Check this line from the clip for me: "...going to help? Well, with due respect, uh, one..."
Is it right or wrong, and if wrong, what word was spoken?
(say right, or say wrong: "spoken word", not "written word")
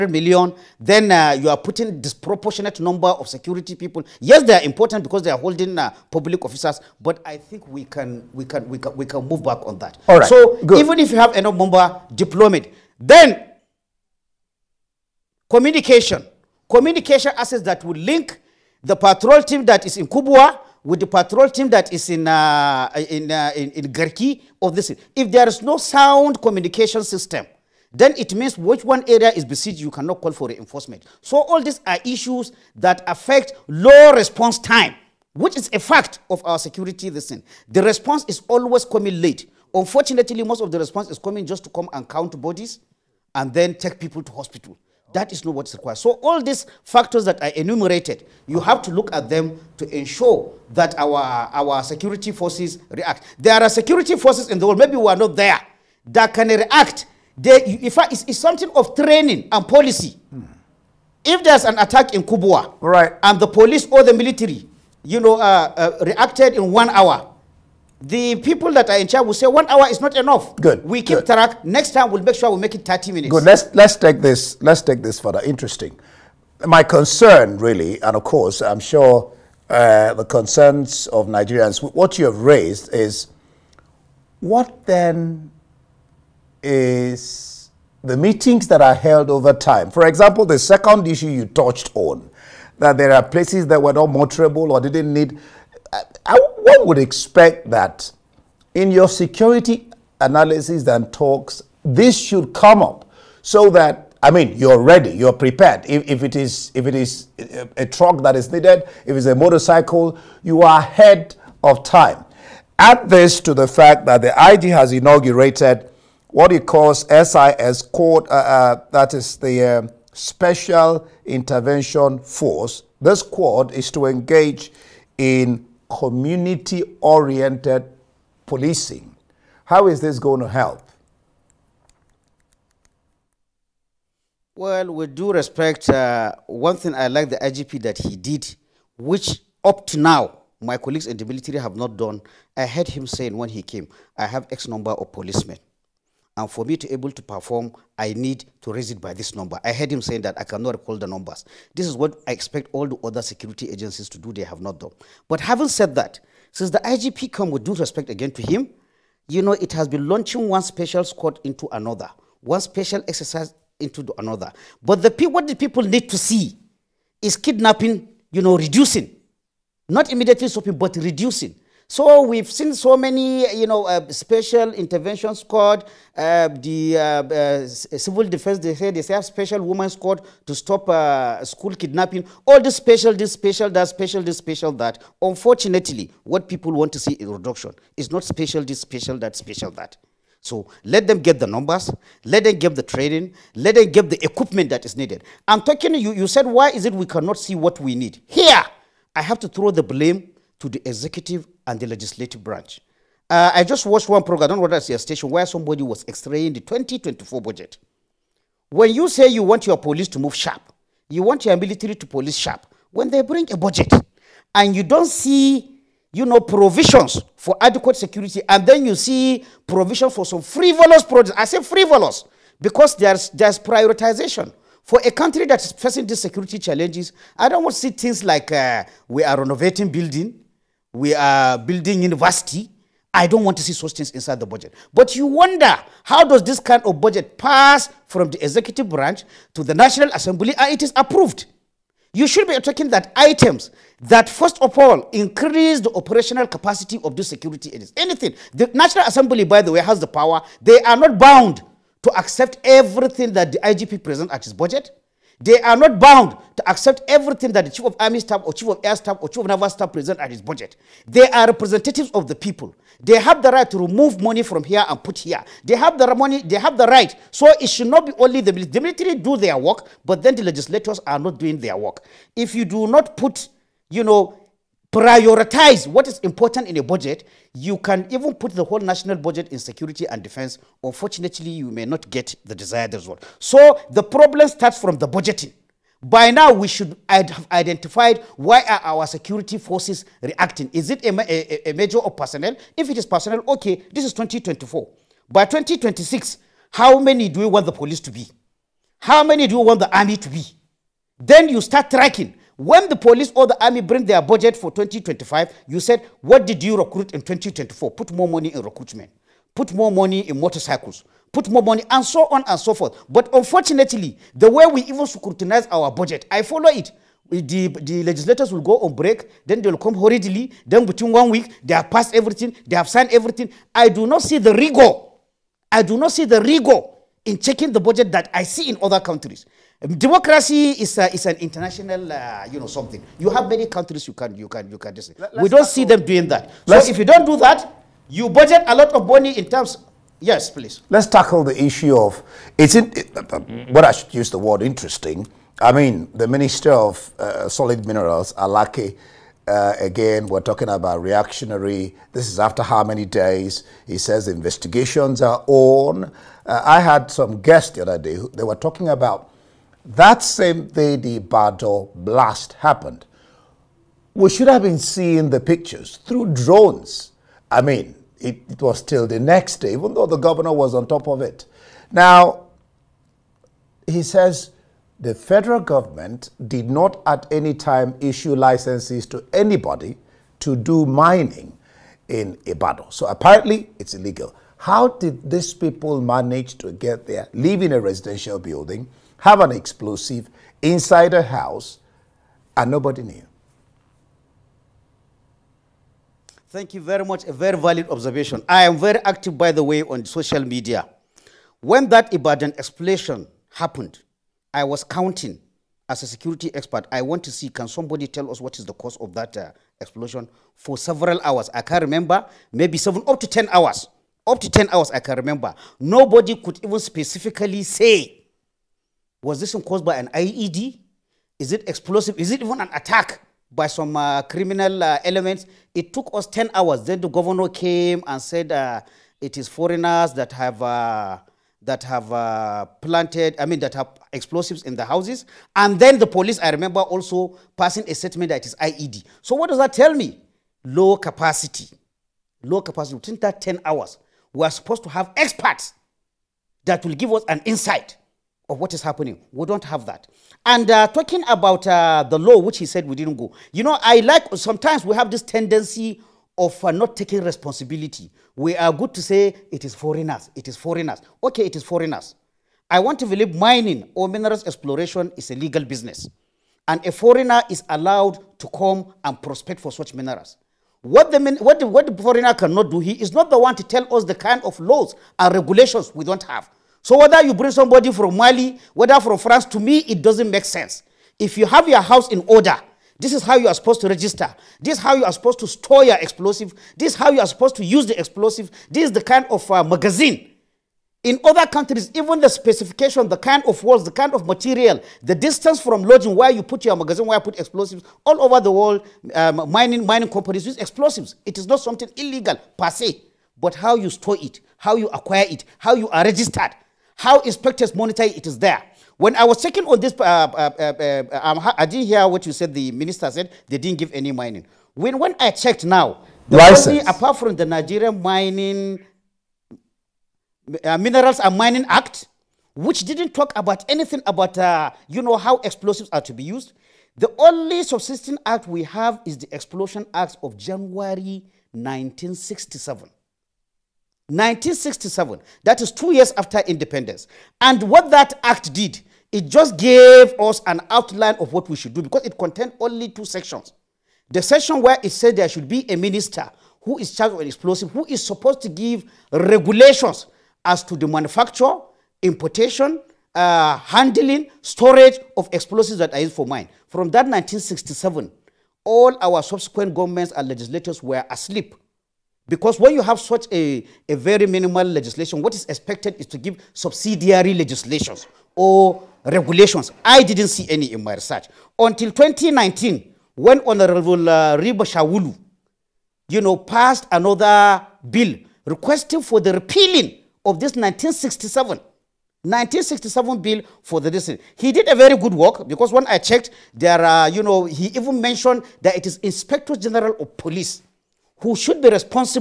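right.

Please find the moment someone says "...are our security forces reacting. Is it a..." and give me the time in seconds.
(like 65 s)
288 s.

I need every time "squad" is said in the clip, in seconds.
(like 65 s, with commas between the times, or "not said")
123 s, 161 s, 175 s, 179 s.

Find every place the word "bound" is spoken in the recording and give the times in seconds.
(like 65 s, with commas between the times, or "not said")
251 s, 255 s.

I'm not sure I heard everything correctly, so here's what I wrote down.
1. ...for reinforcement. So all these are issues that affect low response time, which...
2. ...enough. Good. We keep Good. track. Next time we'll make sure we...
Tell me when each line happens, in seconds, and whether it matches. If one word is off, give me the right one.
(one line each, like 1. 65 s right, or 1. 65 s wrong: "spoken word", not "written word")
1. 30 s right
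2. 70 s right.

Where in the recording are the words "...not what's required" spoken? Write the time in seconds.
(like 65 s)
45 s.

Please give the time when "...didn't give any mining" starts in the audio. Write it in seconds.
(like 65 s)
513 s.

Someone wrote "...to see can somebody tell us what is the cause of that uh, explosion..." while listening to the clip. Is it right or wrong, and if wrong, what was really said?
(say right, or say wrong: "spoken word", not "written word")
right.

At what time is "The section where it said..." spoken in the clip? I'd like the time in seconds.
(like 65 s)
544 s.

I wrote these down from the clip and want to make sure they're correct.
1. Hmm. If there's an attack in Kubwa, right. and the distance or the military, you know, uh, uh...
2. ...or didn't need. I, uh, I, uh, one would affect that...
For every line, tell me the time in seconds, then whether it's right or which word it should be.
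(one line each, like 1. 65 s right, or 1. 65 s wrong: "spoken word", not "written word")
1. 60 s wrong: "police", not "distance"
2. 94 s wrong: "expect", not "affect".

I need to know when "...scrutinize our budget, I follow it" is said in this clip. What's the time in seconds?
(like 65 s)
315 s.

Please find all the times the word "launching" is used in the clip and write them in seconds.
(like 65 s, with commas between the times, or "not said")
160 s.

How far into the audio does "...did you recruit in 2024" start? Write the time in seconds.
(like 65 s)
306 s.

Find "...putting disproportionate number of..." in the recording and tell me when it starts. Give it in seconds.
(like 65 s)
1 s.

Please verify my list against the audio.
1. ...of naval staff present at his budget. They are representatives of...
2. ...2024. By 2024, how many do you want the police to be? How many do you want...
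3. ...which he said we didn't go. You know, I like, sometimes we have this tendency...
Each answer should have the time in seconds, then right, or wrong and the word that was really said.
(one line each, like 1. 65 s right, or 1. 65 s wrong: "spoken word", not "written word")
1. 259 s right
2. 294 s wrong: "2026", not "2024"
3. 452 s right.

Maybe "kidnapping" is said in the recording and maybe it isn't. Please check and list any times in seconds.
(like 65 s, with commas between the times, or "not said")
167 s, 181 s.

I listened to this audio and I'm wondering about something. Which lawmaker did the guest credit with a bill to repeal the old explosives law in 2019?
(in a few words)
Rima Shawulu.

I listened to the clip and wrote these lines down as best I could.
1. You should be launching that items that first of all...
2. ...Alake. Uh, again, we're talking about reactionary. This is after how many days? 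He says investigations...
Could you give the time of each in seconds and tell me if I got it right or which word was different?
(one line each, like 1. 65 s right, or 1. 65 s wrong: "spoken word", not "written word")
1. 242 s wrong: "attacking", not "launching"
2. 348 s right.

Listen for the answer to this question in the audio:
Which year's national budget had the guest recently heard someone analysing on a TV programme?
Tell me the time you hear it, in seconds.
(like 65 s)
206 s.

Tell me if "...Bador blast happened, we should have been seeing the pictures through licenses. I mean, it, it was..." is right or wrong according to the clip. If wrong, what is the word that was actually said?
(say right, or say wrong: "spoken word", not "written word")
wrong: "drones", not "licenses".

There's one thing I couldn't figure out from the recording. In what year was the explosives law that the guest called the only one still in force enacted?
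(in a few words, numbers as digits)
1967.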